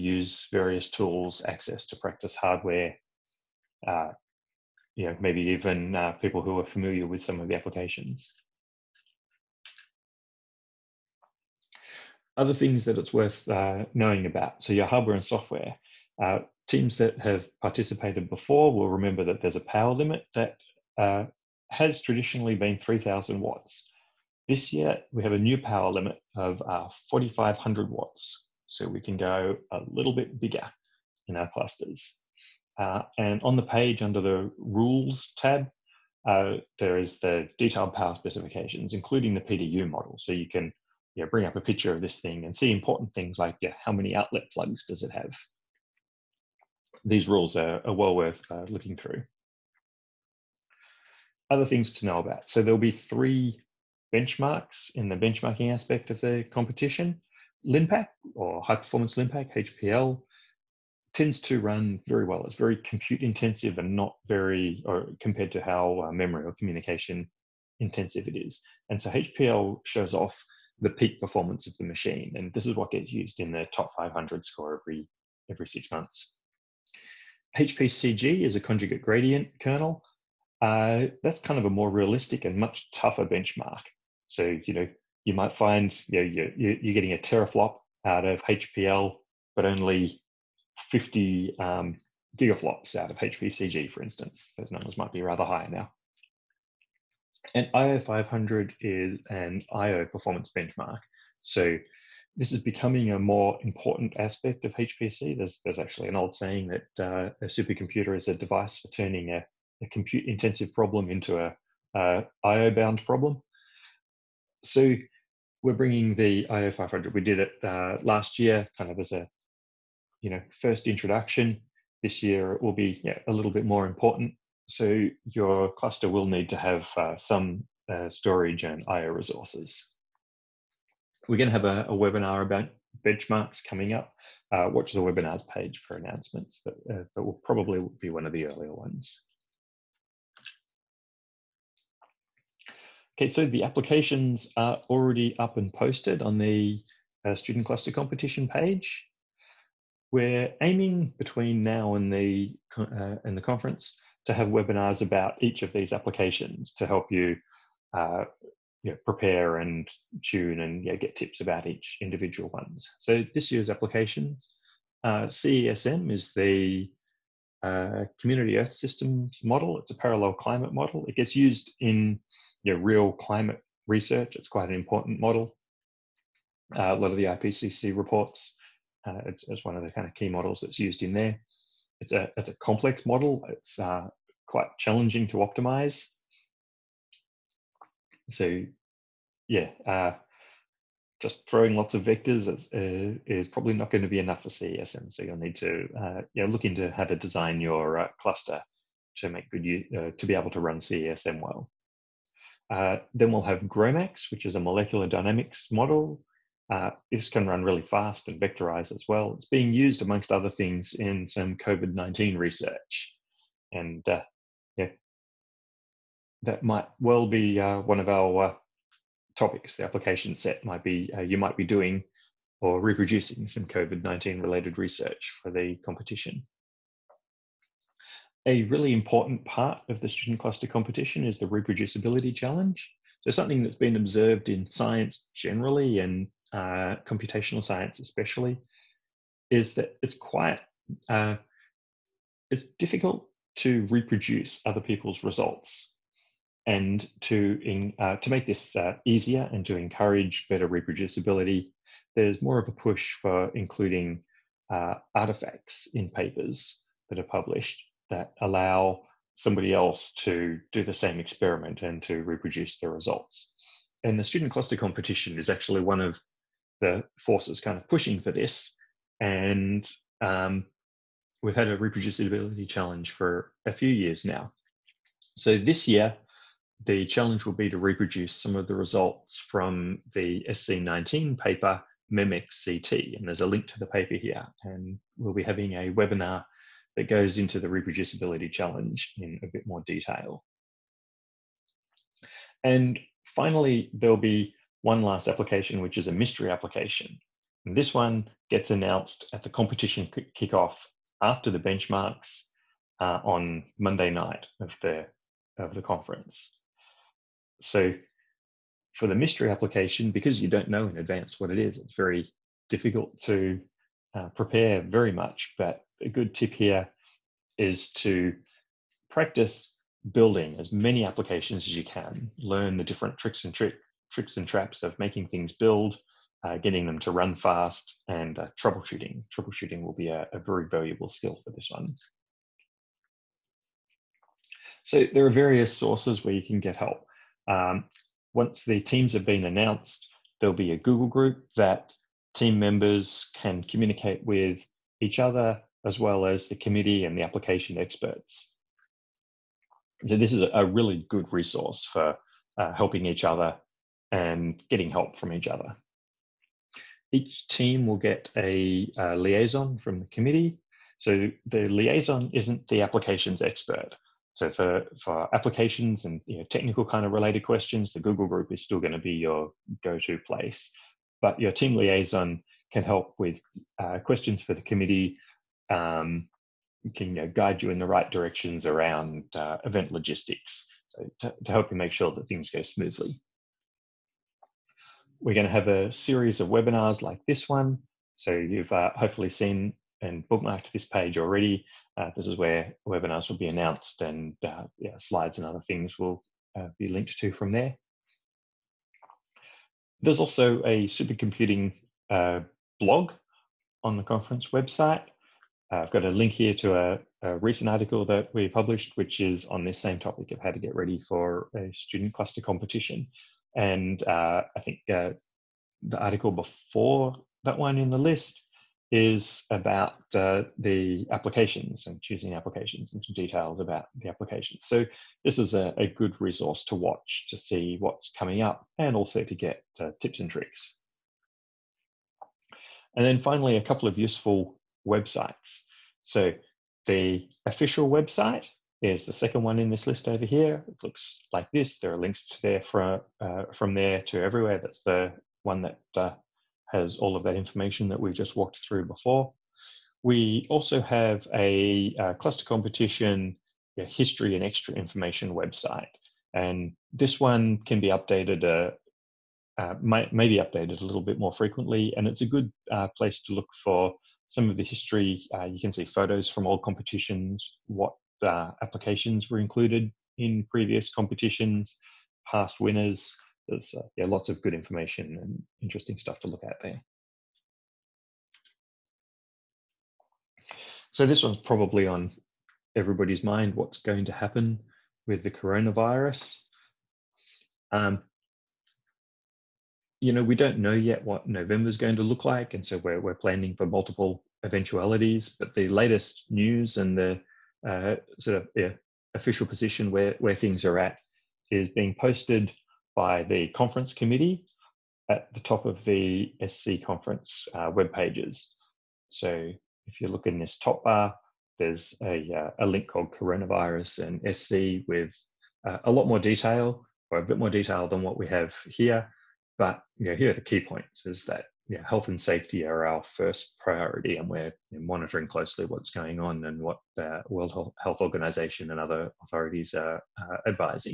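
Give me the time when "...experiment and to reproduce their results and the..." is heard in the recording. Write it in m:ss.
4:21.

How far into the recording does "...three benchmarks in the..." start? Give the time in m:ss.
0:52.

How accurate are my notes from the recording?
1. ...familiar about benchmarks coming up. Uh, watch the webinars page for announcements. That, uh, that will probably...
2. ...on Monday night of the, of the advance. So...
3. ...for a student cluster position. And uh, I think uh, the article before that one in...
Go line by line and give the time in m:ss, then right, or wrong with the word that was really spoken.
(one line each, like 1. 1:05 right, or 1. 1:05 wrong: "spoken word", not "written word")
1. 2:11 wrong: "webinar", not "familiar"
2. 5:03 wrong: "conference", not "advance"
3. 6:51 wrong: "competition", not "position".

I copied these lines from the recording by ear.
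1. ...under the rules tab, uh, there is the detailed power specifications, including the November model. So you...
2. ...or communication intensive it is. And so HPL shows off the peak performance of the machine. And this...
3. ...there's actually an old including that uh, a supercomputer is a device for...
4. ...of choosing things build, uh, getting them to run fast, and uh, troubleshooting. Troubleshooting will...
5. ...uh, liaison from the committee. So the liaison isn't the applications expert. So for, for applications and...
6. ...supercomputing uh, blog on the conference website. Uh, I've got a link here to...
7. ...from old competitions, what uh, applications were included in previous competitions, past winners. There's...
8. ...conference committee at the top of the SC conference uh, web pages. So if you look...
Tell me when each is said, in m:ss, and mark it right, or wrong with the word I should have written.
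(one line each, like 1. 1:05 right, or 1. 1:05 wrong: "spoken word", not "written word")
1. 0:33 wrong: "PDU", not "November"
2. 1:06 right
3. 1:45 wrong: "saying", not "including"
4. 5:24 wrong: "making", not "choosing"
5. 5:59 right
6. 6:40 right
7. 7:46 right
8. 8:23 right.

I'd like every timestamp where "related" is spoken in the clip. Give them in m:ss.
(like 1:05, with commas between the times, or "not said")
3:44, 6:07.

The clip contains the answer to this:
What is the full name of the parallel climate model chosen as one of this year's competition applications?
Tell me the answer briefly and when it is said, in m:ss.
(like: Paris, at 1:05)
Community Earth Systems model, at 2:48.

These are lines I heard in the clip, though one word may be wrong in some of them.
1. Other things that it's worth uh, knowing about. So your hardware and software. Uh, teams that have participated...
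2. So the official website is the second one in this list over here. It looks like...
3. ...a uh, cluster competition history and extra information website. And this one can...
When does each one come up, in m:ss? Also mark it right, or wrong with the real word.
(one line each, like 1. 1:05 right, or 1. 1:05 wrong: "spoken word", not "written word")
1. 0:12 right
2. 7:16 right
3. 7:31 right.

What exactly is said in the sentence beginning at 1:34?
Those numbers might be rather high now.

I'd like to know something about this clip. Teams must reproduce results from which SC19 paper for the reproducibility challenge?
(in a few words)
Mimic CT.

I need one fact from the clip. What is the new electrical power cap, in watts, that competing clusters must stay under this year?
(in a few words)
4,500 watts.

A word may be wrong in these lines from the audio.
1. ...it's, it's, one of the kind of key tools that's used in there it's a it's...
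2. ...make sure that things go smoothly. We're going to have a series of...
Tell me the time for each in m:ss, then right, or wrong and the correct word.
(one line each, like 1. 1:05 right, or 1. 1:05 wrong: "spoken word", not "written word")
1. 2:59 wrong: "models", not "tools"
2. 6:21 right.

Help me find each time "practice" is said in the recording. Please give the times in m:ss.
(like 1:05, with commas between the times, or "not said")
0:01, 5:19.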